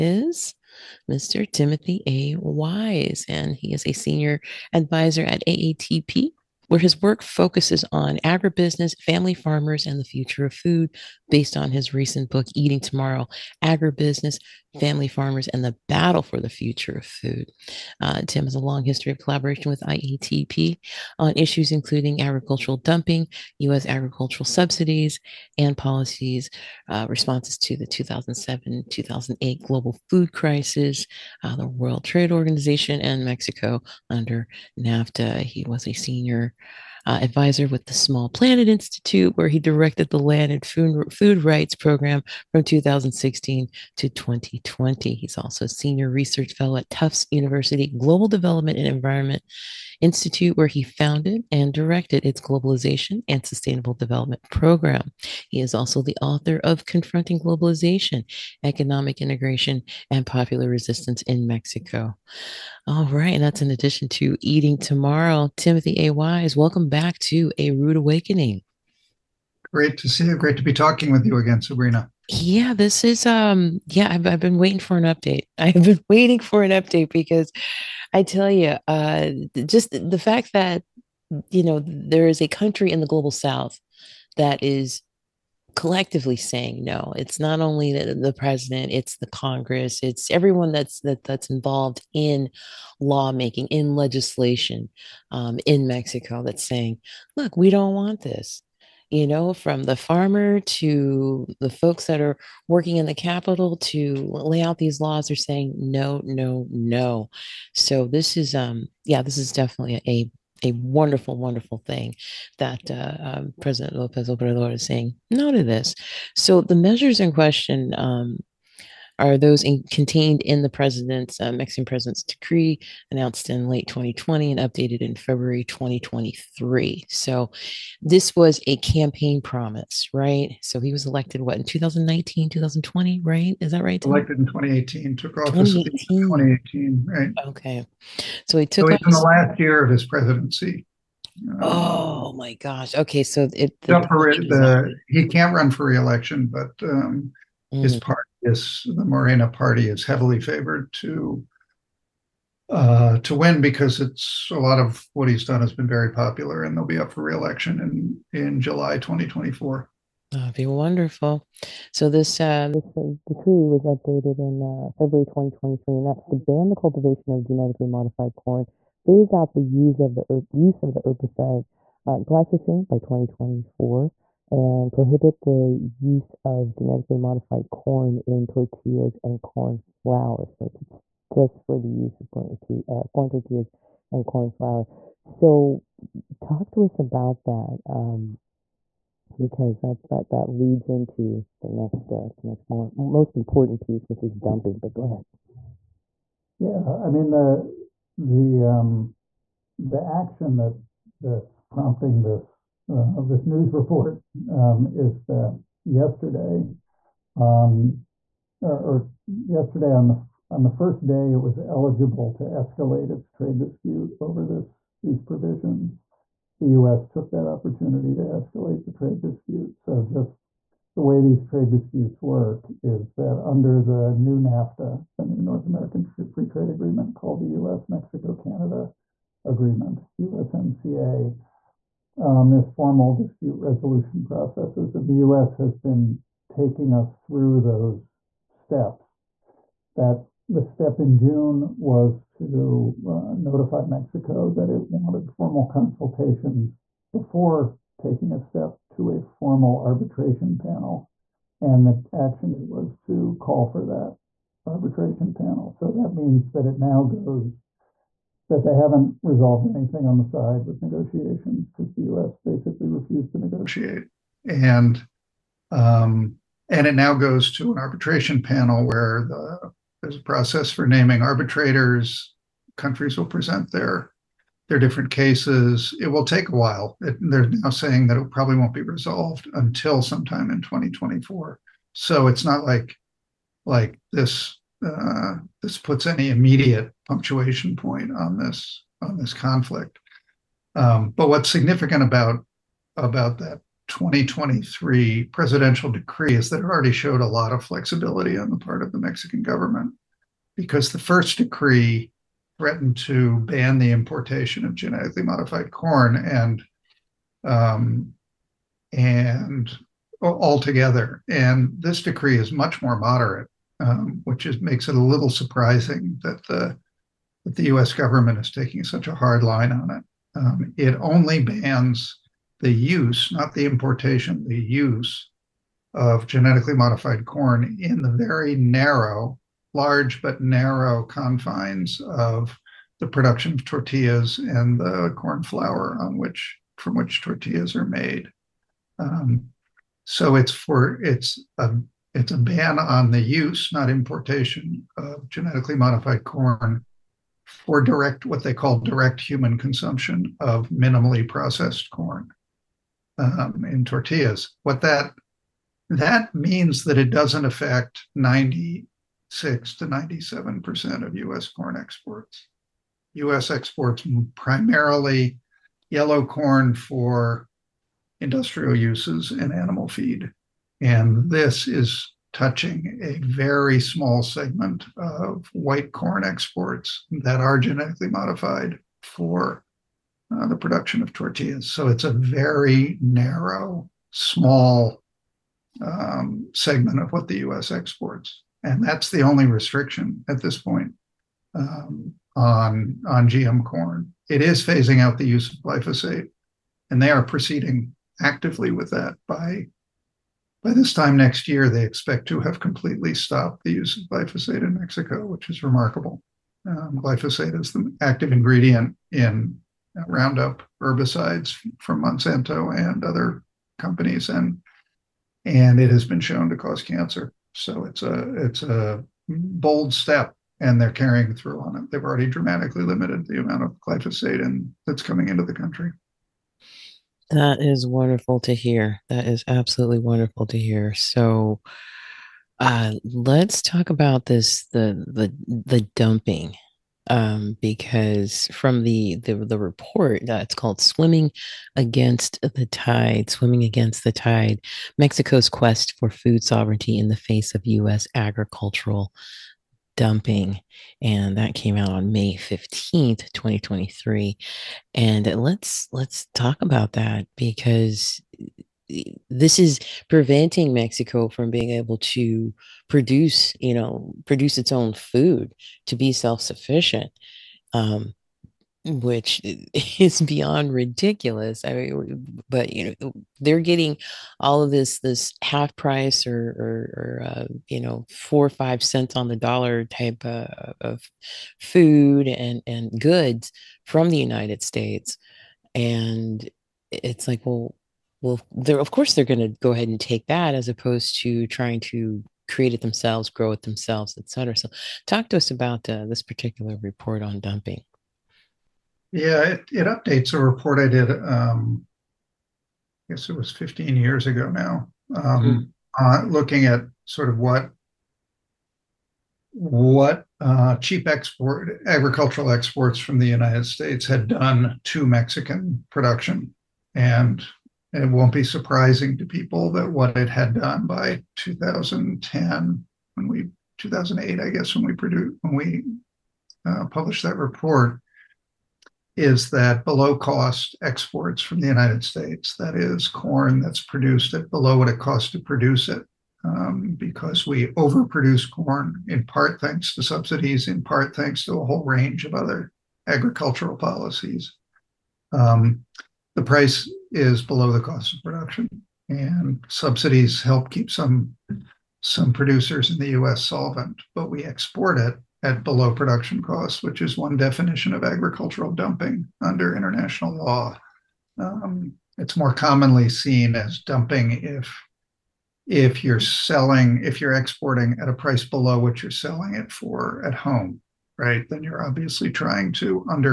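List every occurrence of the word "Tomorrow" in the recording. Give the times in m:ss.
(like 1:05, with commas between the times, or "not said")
0:12, 1:04.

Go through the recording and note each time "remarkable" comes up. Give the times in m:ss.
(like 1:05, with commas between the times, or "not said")
6:45.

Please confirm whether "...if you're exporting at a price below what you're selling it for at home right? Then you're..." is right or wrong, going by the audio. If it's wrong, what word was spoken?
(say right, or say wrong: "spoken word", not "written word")
right.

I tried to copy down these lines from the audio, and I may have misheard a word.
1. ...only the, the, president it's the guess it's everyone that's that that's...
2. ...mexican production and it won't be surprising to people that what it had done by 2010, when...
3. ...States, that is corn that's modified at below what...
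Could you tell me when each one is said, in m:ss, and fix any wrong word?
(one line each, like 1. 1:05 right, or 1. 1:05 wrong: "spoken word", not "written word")
1. 1:27 wrong: "congress", not "guess"
2. 8:35 right
3. 8:52 wrong: "produced", not "modified".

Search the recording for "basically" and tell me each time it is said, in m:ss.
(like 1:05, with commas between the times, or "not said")
4:22.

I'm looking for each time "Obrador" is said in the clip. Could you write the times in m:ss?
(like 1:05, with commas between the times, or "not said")
1:54.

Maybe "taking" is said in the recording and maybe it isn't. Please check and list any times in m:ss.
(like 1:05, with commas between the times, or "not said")
3:56, 4:07, 5:18.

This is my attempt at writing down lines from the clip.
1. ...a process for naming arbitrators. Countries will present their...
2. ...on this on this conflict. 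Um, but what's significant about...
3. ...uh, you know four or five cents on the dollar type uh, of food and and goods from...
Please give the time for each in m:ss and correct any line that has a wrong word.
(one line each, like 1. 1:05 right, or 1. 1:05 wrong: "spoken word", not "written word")
1. 4:30 right
2. 4:48 right
3. 7:57 right.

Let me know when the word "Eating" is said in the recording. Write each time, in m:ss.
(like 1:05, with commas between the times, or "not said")
0:12, 1:04.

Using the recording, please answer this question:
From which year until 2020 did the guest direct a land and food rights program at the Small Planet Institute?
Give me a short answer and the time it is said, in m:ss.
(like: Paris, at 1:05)
2016, at 0:42.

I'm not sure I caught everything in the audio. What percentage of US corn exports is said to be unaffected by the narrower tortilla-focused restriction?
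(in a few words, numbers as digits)
96 to 97 percent.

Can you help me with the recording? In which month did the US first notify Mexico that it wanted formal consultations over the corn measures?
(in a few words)
June.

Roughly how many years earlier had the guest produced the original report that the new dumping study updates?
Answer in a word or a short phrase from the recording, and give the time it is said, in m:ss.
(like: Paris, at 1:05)
15, at 8:23.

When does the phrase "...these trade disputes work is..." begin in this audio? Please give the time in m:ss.
3:41.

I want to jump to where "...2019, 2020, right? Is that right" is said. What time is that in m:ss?
2:11.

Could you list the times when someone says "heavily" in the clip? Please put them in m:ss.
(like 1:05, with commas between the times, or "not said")
2:30.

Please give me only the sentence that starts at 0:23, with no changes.
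agricultural subsidies, and policies uh, responses to the 2007 2008 global food crisis, uh, the World Trade Organization, and Mexico under NAFTA.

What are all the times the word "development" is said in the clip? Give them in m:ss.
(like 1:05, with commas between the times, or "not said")
0:48, 0:53.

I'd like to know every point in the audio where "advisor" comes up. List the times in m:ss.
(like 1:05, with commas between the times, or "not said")
0:04, 0:37.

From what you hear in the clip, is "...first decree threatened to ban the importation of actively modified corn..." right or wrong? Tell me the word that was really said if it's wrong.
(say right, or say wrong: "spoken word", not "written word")
wrong: "genetically", not "actively".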